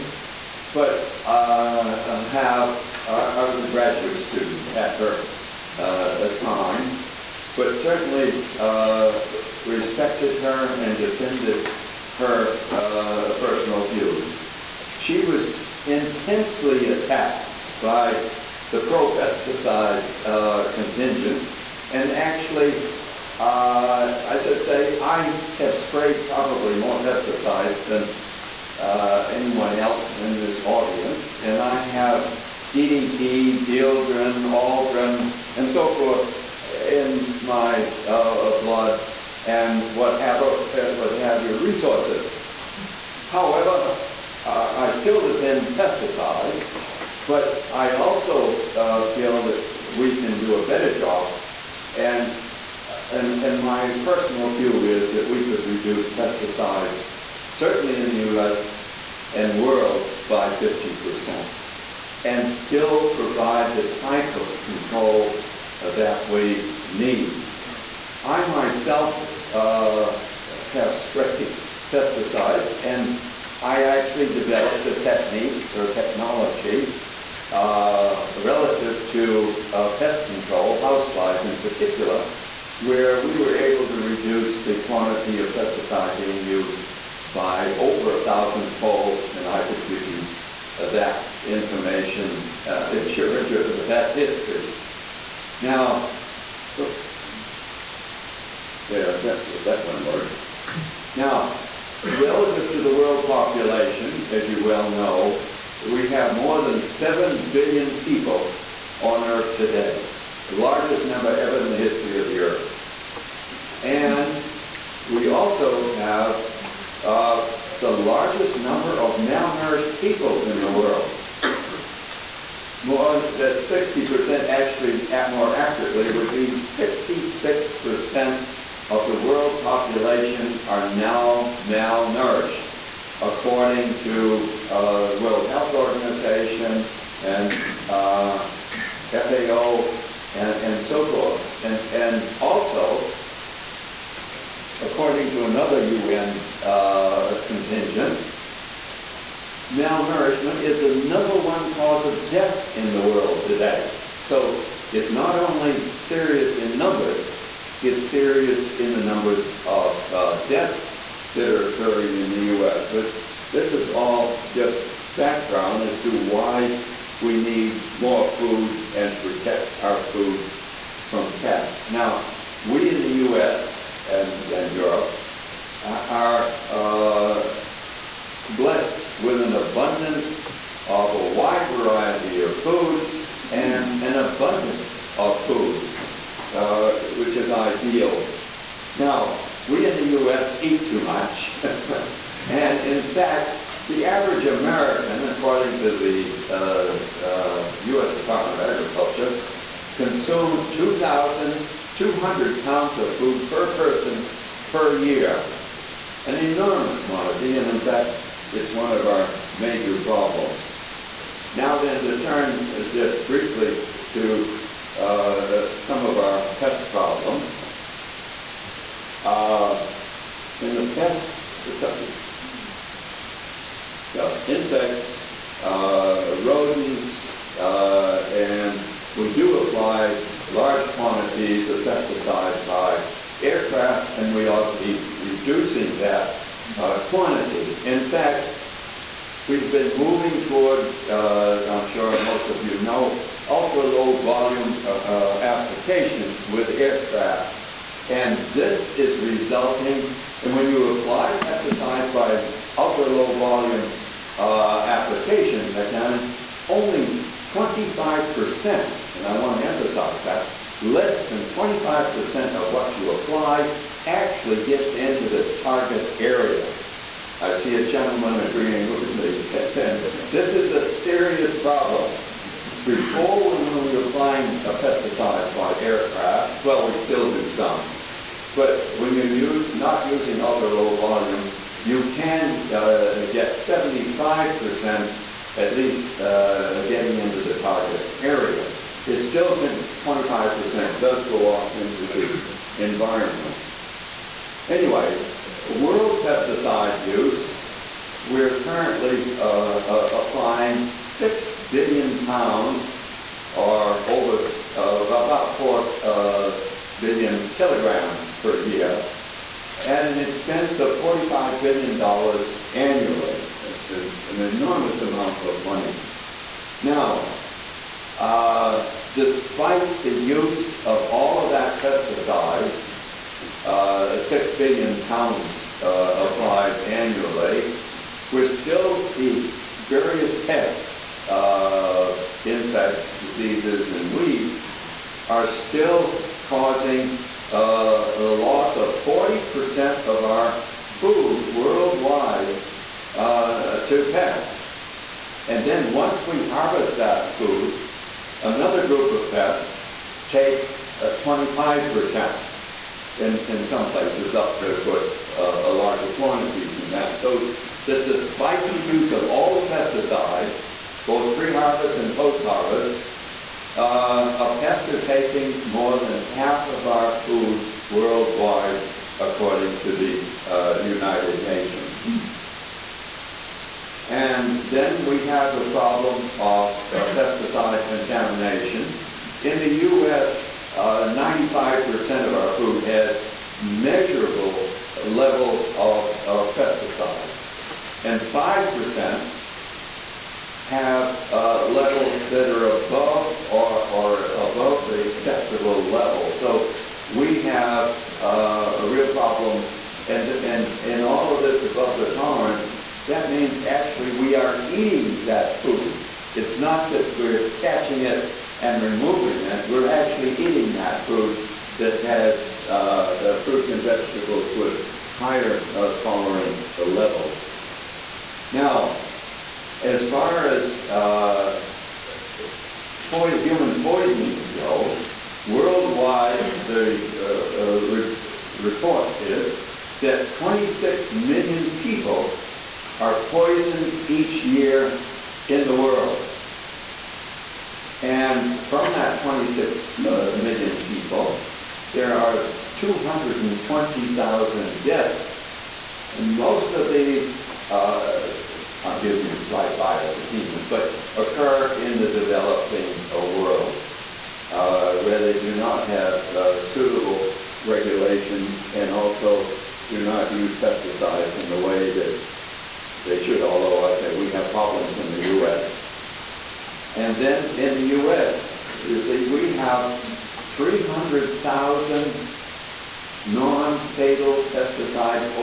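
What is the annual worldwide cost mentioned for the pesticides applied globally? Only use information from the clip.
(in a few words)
$45 billion.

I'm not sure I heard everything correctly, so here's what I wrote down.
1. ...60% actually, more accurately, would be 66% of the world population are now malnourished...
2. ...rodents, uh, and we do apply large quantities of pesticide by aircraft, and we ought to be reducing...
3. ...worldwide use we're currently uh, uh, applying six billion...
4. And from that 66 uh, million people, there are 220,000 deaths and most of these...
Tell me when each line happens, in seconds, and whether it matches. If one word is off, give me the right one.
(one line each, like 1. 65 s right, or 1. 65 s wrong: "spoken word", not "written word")
1. 123 s right
2. 226 s right
3. 296 s wrong: "pesticide", not "worldwide"
4. 438 s wrong: "26", not "66".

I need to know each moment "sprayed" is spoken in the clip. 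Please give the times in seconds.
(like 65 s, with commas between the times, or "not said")
25 s, 70 s.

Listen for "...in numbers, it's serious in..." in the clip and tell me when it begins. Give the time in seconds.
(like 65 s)
156 s.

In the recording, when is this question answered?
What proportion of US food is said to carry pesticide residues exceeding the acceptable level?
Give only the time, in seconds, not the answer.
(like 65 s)
388 s.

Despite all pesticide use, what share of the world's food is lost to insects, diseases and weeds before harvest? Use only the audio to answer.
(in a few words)
40%.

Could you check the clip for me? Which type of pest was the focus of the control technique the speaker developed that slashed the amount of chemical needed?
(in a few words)
houseflies.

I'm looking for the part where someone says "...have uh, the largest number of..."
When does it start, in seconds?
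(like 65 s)
115 s.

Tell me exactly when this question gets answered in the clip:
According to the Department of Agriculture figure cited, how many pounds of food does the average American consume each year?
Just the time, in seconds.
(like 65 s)
200 s.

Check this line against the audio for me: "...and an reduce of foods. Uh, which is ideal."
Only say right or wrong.
wrong.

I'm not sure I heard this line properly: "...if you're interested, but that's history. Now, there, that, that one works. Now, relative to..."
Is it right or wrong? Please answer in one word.
right.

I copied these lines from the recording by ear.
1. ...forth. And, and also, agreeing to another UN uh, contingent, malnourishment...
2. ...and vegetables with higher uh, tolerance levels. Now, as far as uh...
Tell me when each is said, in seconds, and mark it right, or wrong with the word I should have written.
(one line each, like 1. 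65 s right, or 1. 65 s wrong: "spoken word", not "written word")
1. 141 s wrong: "according", not "agreeing"
2. 413 s right.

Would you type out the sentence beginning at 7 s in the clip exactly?
But certainly, uh, respected her and defended her uh, personal views.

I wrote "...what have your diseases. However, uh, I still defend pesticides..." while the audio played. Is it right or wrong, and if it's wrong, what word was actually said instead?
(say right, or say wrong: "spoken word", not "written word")
wrong: "resources", not "diseases".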